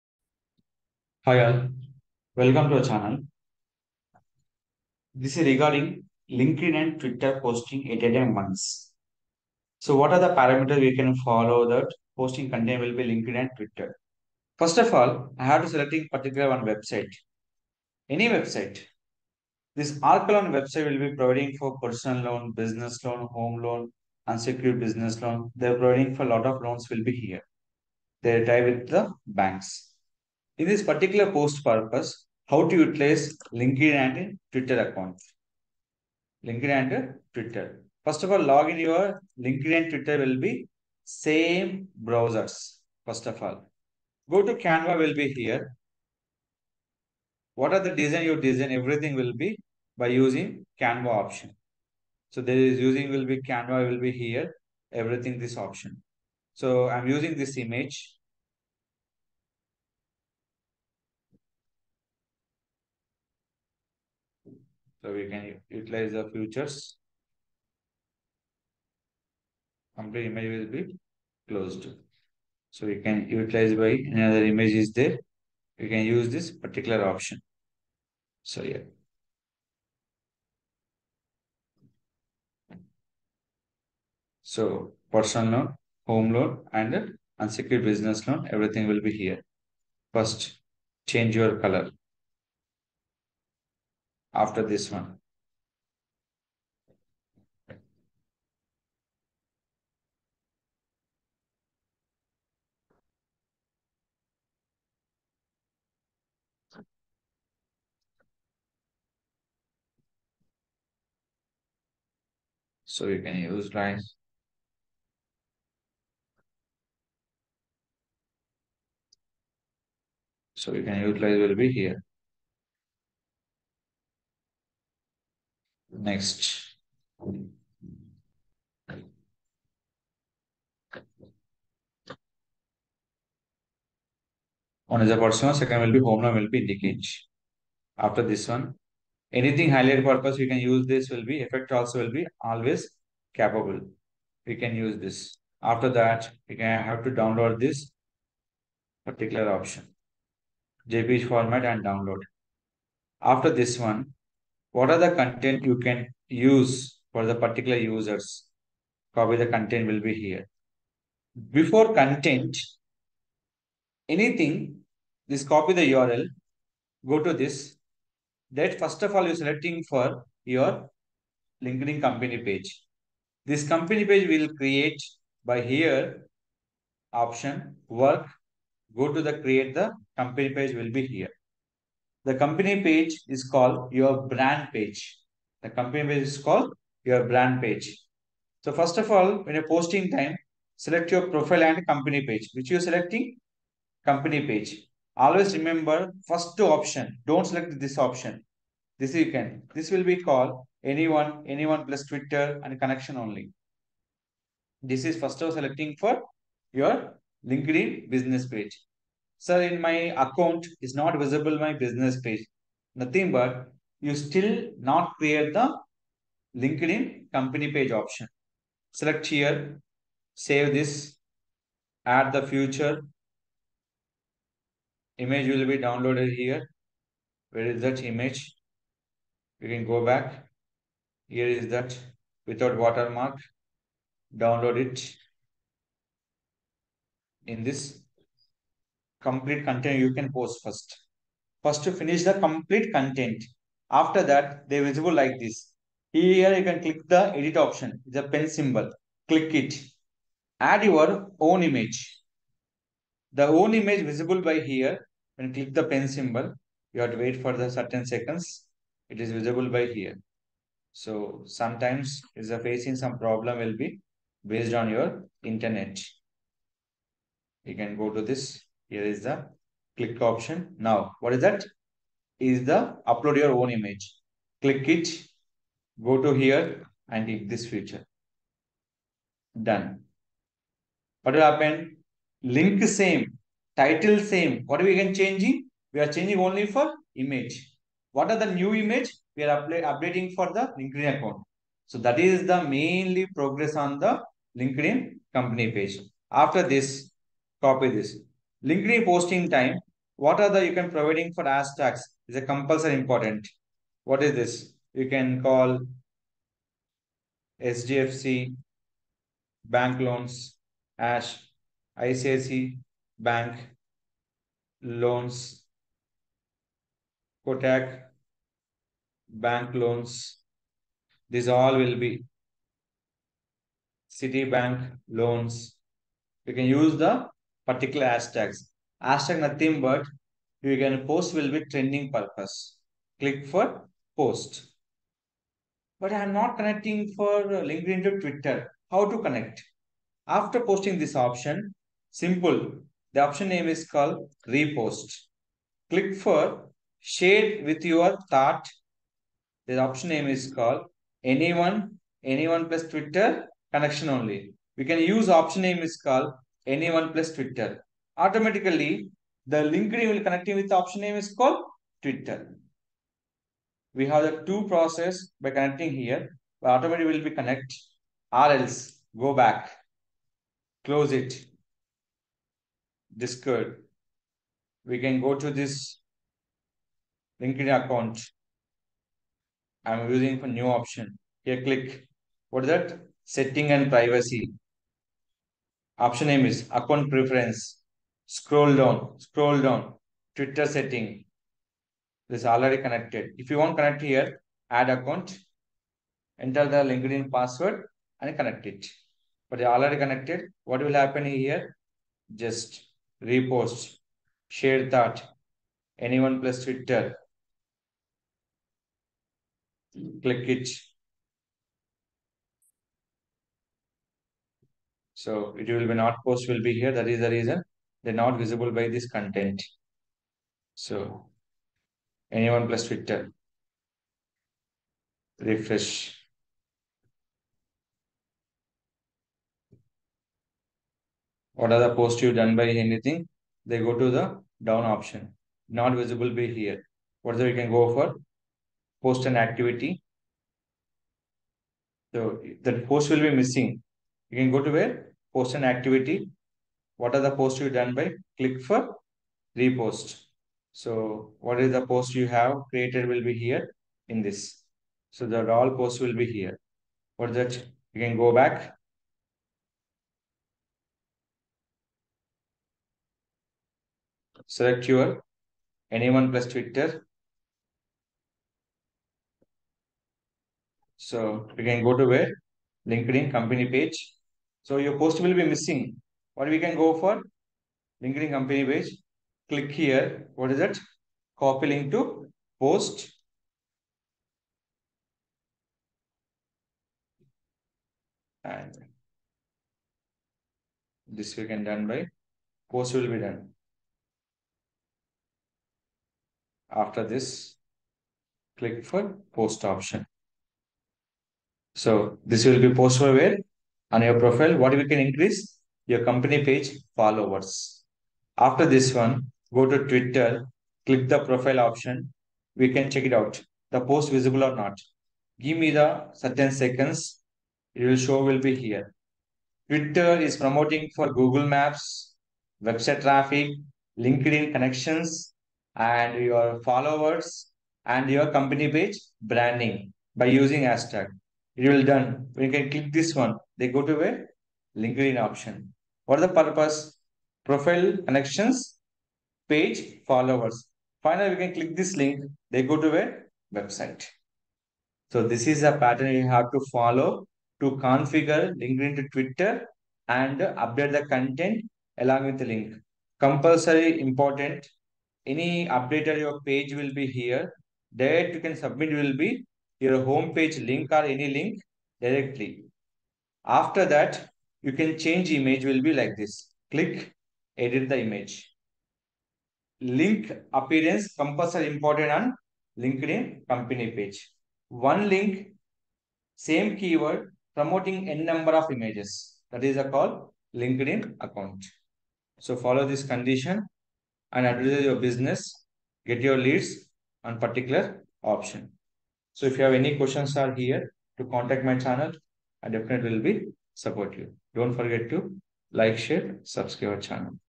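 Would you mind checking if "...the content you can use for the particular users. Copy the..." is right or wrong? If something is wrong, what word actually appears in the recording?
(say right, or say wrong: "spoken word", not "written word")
right.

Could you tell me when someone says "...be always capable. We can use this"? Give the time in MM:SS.
02:22.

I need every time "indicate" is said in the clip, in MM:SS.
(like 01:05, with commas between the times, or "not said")
02:16.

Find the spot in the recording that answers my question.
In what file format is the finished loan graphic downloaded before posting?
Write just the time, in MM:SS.
02:30.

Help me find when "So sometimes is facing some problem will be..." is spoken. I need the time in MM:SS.
04:20.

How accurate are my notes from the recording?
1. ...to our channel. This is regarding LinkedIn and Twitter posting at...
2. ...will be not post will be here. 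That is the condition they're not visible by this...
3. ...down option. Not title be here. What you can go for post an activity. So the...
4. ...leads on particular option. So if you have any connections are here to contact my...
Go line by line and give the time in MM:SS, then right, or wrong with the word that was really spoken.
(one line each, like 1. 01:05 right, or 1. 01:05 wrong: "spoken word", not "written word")
1. 00:02 right
2. 06:55 wrong: "reason", not "condition"
3. 07:14 wrong: "visible", not "title"
4. 09:46 wrong: "questions", not "connections".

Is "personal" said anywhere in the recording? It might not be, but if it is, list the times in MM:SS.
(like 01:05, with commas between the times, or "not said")
00:21, 01:25.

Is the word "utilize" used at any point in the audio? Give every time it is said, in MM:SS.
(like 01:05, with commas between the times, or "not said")
00:32, 01:05, 01:13, 02:01.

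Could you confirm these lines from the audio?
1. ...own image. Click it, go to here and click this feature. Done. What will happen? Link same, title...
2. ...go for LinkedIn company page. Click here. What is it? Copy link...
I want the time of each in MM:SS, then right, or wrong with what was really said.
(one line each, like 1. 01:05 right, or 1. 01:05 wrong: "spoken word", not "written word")
1. 04:33 right
2. 07:56 right.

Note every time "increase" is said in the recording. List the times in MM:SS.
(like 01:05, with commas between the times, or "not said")
08:24.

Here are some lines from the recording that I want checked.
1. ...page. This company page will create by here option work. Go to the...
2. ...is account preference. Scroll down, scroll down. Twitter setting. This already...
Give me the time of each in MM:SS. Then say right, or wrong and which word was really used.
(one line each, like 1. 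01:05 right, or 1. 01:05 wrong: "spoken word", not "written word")
1. 02:52 right
2. 06:26 right.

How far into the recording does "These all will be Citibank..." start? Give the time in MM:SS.
05:21.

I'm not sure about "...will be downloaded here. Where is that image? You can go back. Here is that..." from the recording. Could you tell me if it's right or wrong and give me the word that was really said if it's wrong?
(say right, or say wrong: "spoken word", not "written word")
right.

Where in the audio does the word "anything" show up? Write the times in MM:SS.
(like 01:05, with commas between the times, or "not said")
02:19, 02:44, 07:12.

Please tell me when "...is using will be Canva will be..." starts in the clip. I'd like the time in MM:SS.
00:52.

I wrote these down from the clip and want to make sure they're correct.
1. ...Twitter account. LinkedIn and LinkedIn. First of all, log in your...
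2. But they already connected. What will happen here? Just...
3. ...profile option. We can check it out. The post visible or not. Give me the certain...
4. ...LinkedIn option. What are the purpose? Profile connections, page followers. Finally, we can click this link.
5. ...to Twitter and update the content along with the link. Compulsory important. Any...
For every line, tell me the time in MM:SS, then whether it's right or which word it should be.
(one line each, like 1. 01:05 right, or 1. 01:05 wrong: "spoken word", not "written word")
1. 00:34 wrong: "Twitter", not "LinkedIn"
2. 06:39 right
3. 08:31 right
4. 08:54 right
5. 09:08 right.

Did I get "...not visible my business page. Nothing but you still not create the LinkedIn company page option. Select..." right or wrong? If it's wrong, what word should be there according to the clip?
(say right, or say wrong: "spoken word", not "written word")
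right.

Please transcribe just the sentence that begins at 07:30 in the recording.
So what is the post you have created will be here in this.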